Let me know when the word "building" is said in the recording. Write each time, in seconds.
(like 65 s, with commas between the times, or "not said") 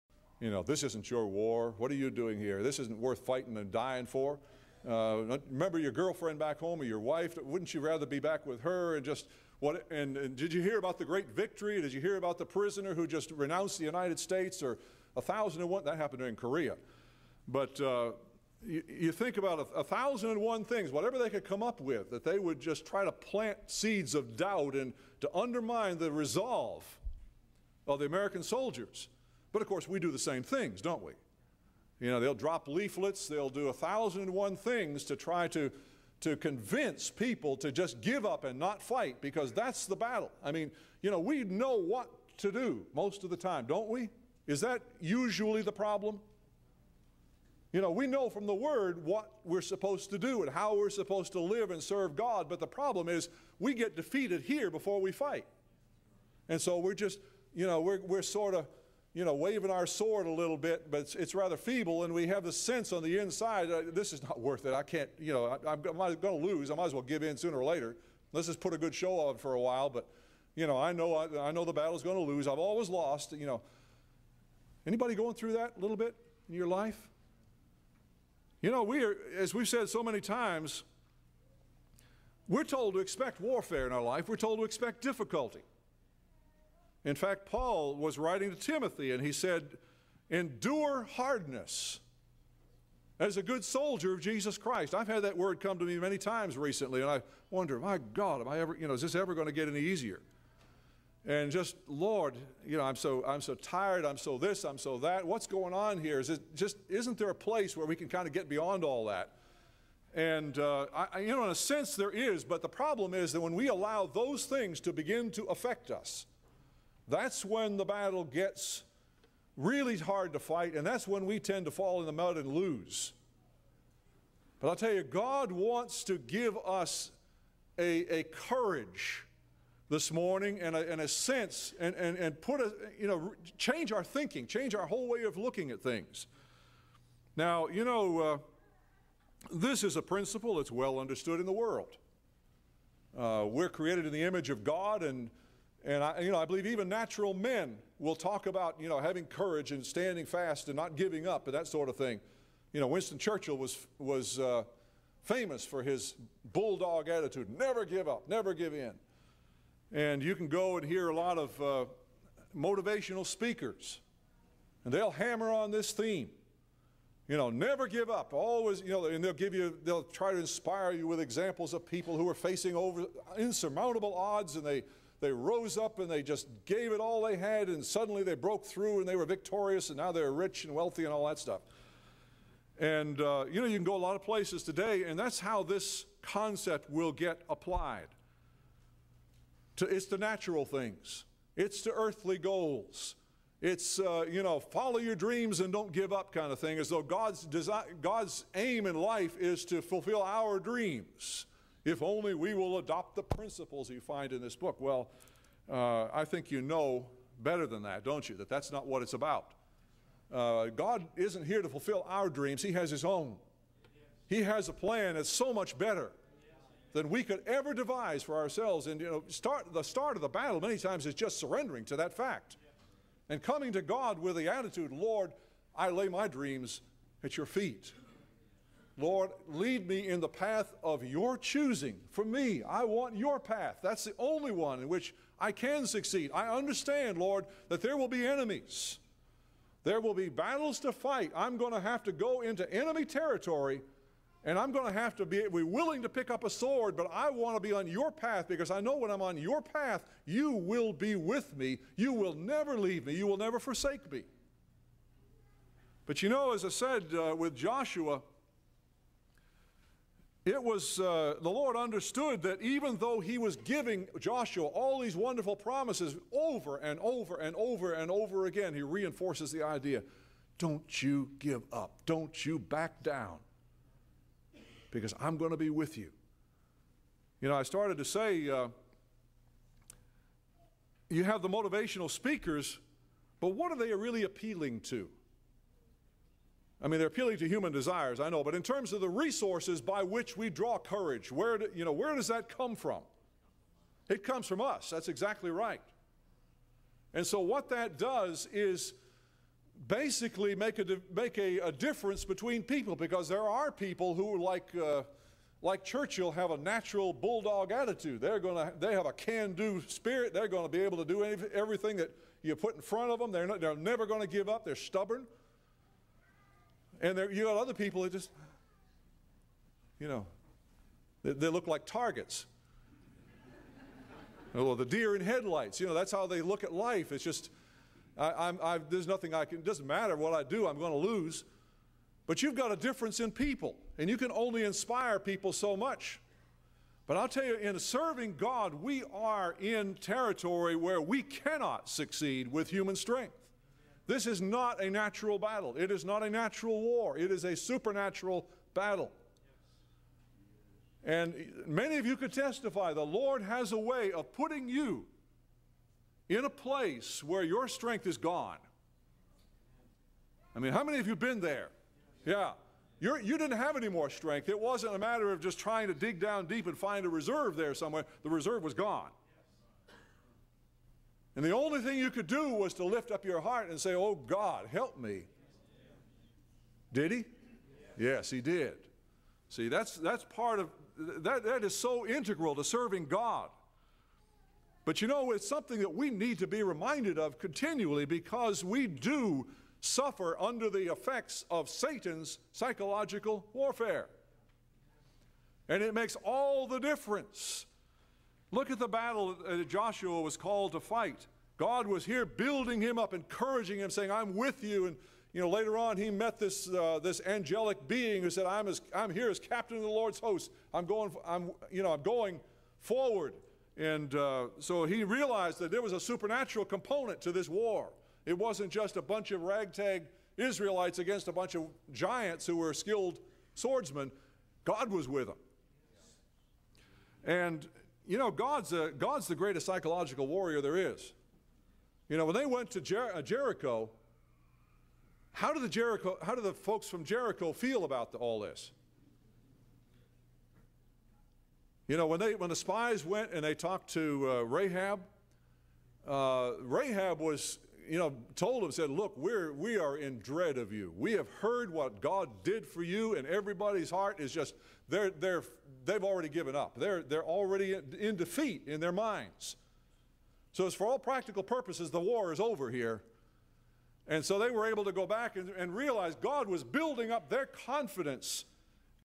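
402 s, 466 s.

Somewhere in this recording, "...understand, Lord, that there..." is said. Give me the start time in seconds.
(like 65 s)
236 s.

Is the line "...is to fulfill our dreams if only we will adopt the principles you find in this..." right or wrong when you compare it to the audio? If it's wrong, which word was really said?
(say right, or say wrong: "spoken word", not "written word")
right.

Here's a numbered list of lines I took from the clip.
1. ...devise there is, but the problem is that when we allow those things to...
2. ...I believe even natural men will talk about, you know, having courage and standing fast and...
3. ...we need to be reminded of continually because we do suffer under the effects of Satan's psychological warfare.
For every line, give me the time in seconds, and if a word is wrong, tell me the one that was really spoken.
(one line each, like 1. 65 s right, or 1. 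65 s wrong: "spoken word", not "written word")
1. 111 s wrong: "sense", not "devise"
2. 146 s right
3. 385 s right.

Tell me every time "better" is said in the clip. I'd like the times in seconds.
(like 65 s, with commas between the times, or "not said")
207 s, 215 s.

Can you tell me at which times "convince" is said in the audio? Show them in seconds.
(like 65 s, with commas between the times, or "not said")
36 s.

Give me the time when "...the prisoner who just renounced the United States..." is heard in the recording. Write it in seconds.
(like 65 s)
12 s.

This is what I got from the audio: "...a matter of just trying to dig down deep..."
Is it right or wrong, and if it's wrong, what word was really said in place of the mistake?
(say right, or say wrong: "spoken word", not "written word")
right.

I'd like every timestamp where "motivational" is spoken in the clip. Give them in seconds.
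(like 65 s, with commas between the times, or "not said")
162 s, 281 s.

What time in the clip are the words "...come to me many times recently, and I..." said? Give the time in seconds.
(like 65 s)
95 s.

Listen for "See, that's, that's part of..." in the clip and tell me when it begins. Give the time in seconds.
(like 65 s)
379 s.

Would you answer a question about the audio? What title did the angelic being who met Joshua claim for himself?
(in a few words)
captain of the Lord's host.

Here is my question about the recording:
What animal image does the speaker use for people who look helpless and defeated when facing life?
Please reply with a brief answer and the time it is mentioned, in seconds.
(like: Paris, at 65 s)
deer in headlights, at 324 s.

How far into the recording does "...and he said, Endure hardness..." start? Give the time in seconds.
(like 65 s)
89 s.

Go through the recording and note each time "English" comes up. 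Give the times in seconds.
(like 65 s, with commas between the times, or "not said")
not said.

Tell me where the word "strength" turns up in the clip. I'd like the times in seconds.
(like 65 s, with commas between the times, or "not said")
342 s, 357 s, 364 s.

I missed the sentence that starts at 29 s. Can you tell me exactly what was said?
But of course, we do the same things, don't we?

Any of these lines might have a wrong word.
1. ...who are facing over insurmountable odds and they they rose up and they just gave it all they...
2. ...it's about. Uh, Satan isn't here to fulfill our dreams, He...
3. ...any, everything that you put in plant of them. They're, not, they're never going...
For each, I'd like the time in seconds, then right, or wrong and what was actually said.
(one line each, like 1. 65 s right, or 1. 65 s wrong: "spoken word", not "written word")
1. 172 s right
2. 209 s wrong: "God", not "Satan"
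3. 311 s wrong: "front", not "plant".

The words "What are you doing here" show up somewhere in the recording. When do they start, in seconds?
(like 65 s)
1 s.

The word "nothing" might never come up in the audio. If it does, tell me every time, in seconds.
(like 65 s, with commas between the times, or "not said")
329 s.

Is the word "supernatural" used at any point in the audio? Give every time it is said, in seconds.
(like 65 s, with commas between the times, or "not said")
347 s, 415 s.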